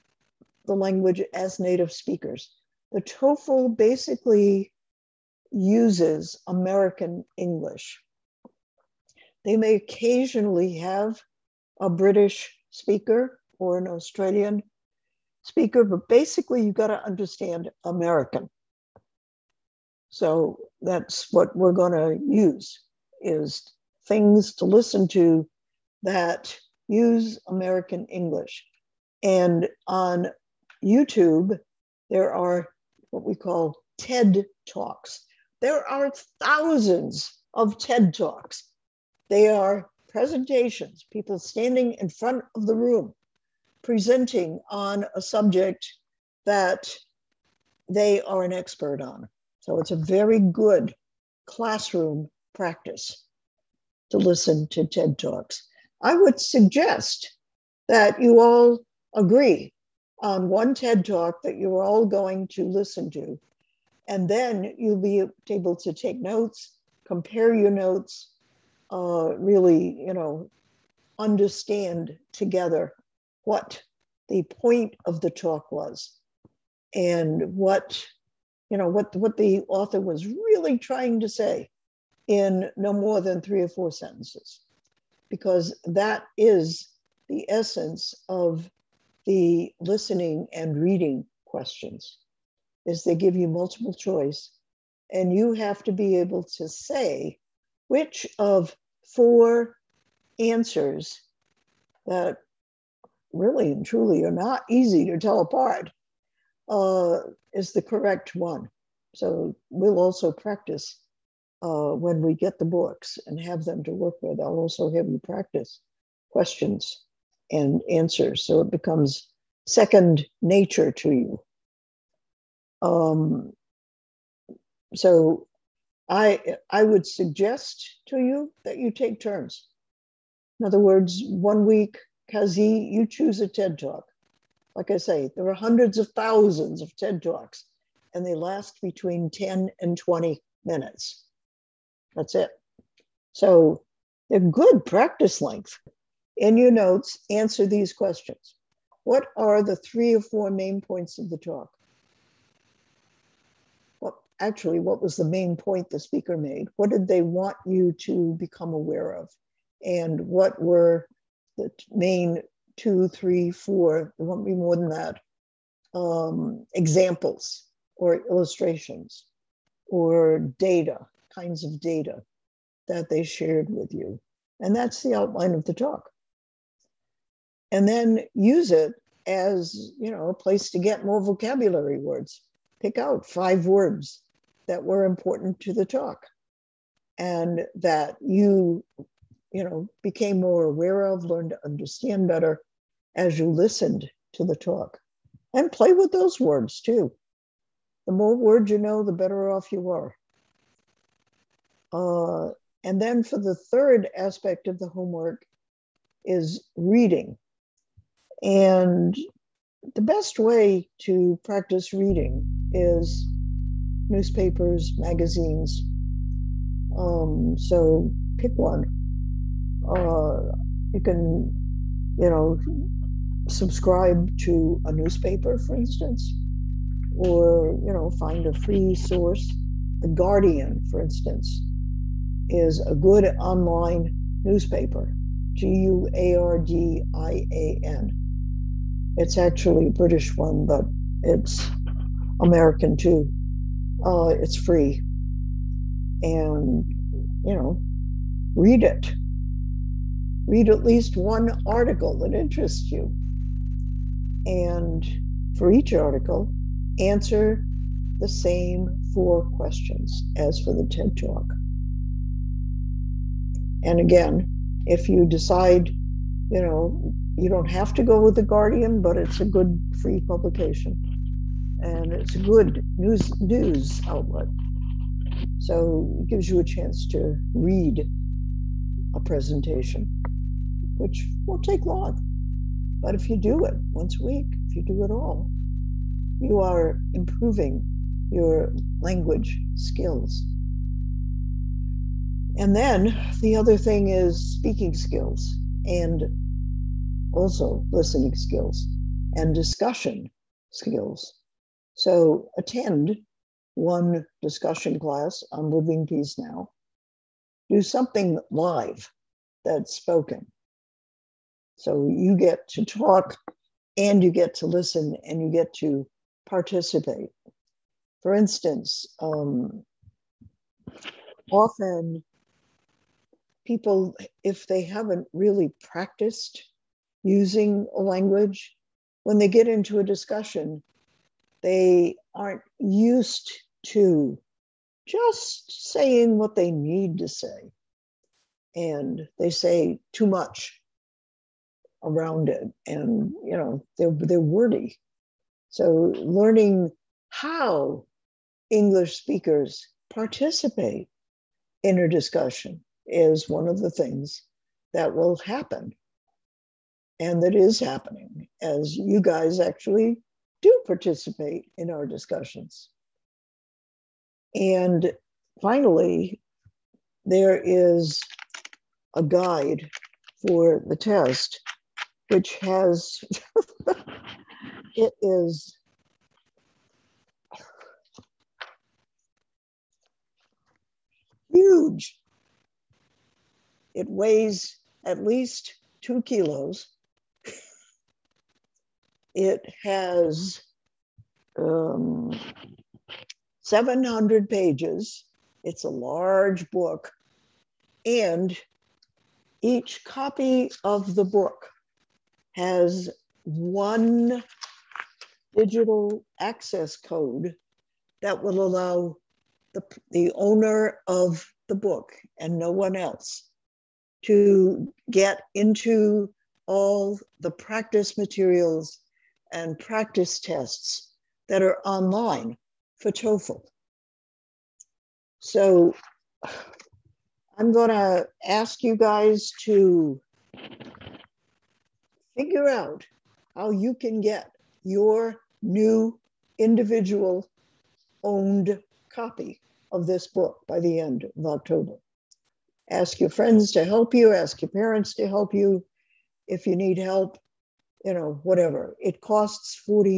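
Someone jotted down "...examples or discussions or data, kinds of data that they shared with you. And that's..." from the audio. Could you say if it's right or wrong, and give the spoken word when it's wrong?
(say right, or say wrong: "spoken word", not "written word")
wrong: "illustrations", not "discussions".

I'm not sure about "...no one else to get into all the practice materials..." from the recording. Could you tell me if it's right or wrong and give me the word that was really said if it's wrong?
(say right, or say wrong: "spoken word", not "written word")
right.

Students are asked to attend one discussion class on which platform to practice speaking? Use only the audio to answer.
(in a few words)
Living Peace Now.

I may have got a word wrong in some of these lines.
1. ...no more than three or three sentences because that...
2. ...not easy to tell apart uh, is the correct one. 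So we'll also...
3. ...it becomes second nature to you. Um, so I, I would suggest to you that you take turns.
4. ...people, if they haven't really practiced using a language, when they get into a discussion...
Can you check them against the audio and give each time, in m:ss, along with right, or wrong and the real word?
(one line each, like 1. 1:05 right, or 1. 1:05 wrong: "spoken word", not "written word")
1. 1:22 wrong: "four", not "three"
2. 1:44 right
3. 1:58 right
4. 5:23 right.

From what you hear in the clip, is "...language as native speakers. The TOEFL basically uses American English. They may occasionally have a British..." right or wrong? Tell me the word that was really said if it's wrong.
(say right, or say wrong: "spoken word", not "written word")
right.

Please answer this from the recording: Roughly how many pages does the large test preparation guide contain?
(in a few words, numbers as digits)
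700.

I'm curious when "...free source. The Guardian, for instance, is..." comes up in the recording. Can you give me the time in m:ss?
3:48.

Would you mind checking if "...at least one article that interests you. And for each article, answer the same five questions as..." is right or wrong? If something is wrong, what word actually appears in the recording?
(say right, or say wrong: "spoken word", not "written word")
wrong: "four", not "five".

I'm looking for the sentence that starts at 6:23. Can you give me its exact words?
It weighs at least two kilos.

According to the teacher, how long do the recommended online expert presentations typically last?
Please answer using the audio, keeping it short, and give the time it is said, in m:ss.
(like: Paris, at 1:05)
10 to 20 minutes, at 2:18.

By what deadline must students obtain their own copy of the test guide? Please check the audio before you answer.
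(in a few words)
end of October.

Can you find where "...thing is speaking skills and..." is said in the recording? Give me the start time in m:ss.
4:53.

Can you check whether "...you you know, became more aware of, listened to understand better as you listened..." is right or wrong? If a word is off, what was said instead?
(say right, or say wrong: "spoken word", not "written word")
wrong: "learned", not "listened".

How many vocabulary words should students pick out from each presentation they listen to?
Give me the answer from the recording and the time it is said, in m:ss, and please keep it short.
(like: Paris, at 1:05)
5, at 3:03.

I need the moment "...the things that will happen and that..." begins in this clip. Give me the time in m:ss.
5:53.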